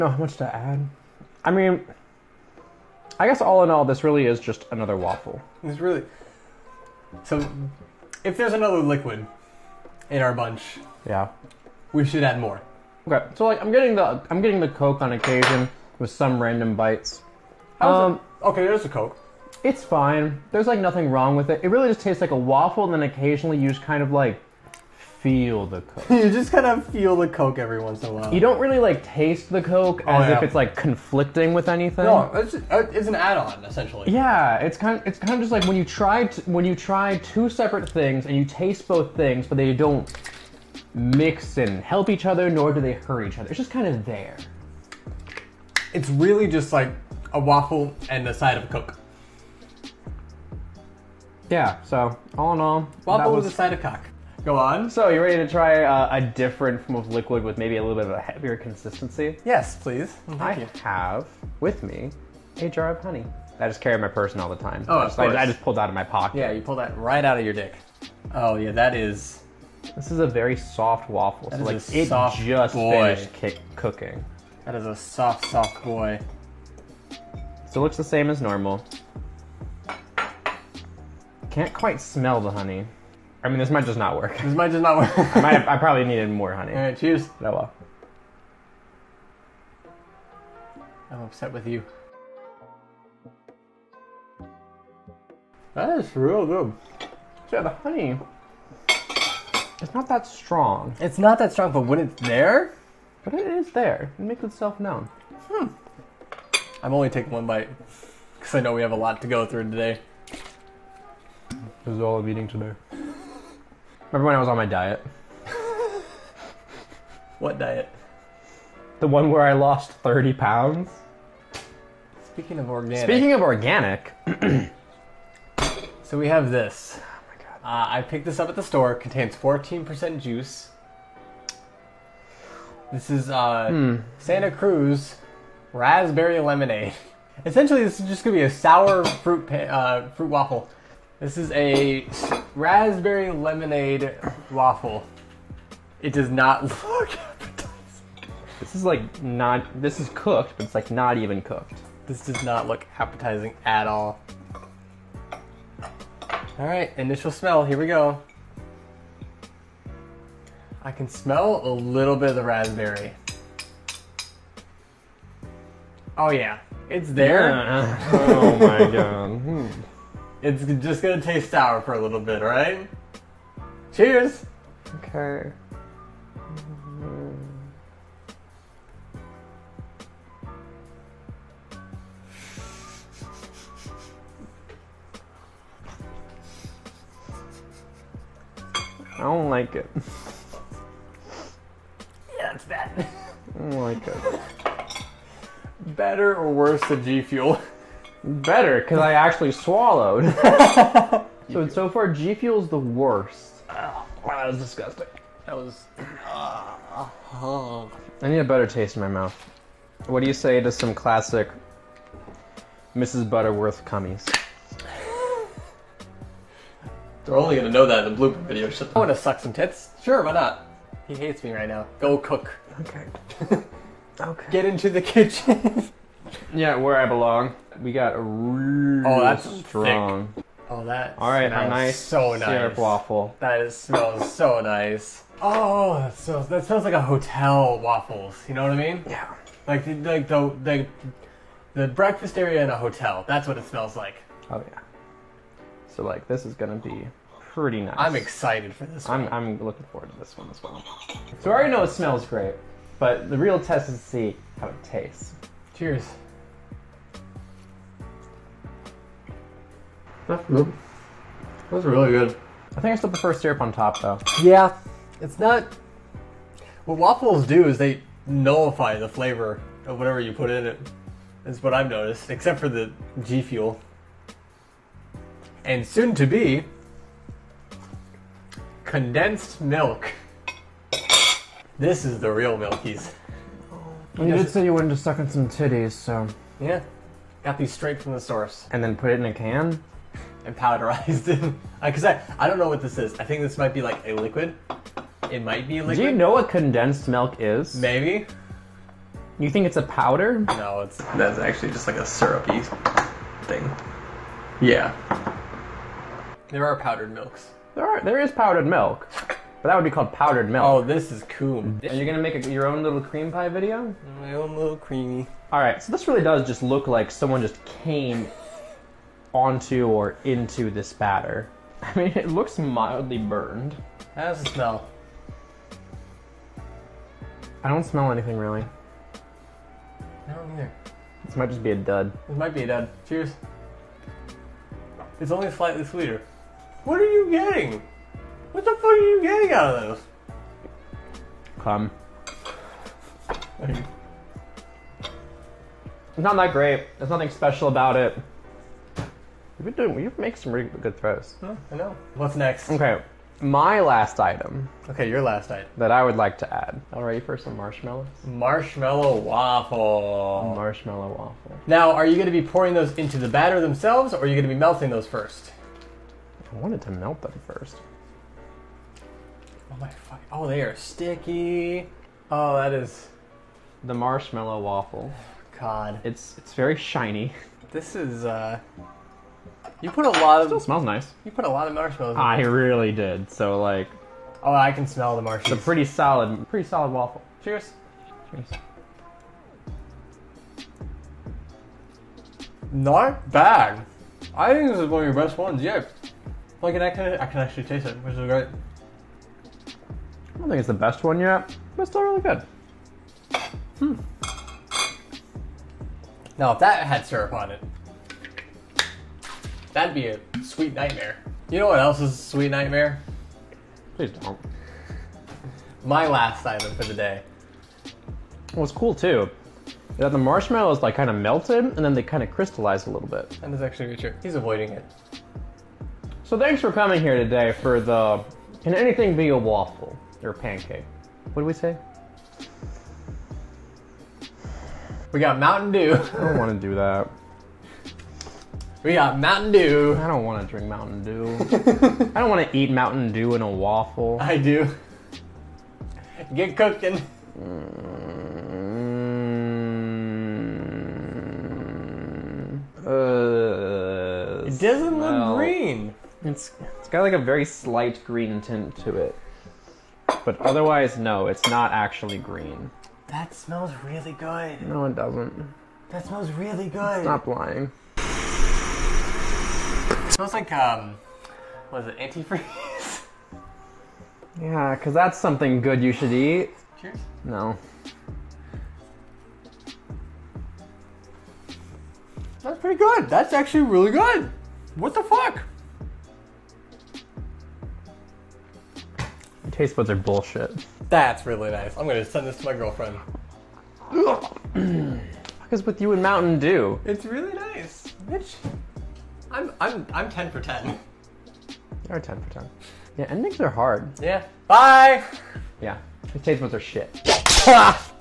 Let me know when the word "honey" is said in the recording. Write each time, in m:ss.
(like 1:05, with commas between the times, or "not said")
1:03, 1:22, 1:26, 1:37.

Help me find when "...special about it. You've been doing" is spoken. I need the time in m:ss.
5:47.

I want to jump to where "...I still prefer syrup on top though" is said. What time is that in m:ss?
4:22.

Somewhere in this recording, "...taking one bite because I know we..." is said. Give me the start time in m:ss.
1:47.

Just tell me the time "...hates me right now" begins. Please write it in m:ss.
3:41.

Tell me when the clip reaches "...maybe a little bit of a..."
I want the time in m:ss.
0:57.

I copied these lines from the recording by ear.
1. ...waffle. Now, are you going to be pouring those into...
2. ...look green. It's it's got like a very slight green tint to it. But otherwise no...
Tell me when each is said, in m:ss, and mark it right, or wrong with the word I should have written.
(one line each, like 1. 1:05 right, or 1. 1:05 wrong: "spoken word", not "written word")
1. 6:01 right
2. 7:34 right.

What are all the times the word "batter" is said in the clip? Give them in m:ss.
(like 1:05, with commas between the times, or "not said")
5:20, 6:03.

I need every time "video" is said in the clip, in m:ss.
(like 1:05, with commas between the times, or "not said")
3:38, 5:13.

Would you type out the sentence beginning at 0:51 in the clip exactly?
Yeah, so all in all, waffle was...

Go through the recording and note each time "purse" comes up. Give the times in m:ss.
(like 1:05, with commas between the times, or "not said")
1:04.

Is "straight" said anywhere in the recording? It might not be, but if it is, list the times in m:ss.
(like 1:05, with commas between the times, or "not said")
4:47.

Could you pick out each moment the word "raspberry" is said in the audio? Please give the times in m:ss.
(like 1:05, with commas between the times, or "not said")
2:15, 2:22, 2:42.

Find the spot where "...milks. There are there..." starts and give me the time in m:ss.
5:07.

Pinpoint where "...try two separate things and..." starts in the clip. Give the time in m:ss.
0:36.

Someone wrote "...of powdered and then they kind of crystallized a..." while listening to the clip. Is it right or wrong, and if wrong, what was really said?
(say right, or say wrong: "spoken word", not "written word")
wrong: "melted", not "powdered".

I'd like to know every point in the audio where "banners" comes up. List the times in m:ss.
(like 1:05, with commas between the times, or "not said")
not said.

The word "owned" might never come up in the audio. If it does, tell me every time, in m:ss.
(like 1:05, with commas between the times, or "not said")
not said.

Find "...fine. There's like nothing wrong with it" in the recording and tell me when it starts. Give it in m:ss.
0:19.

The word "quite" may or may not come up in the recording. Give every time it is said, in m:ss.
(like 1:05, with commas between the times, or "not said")
1:21.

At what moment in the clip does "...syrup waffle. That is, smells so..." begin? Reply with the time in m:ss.
3:52.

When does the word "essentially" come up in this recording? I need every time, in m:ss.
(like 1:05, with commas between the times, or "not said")
0:33, 2:17.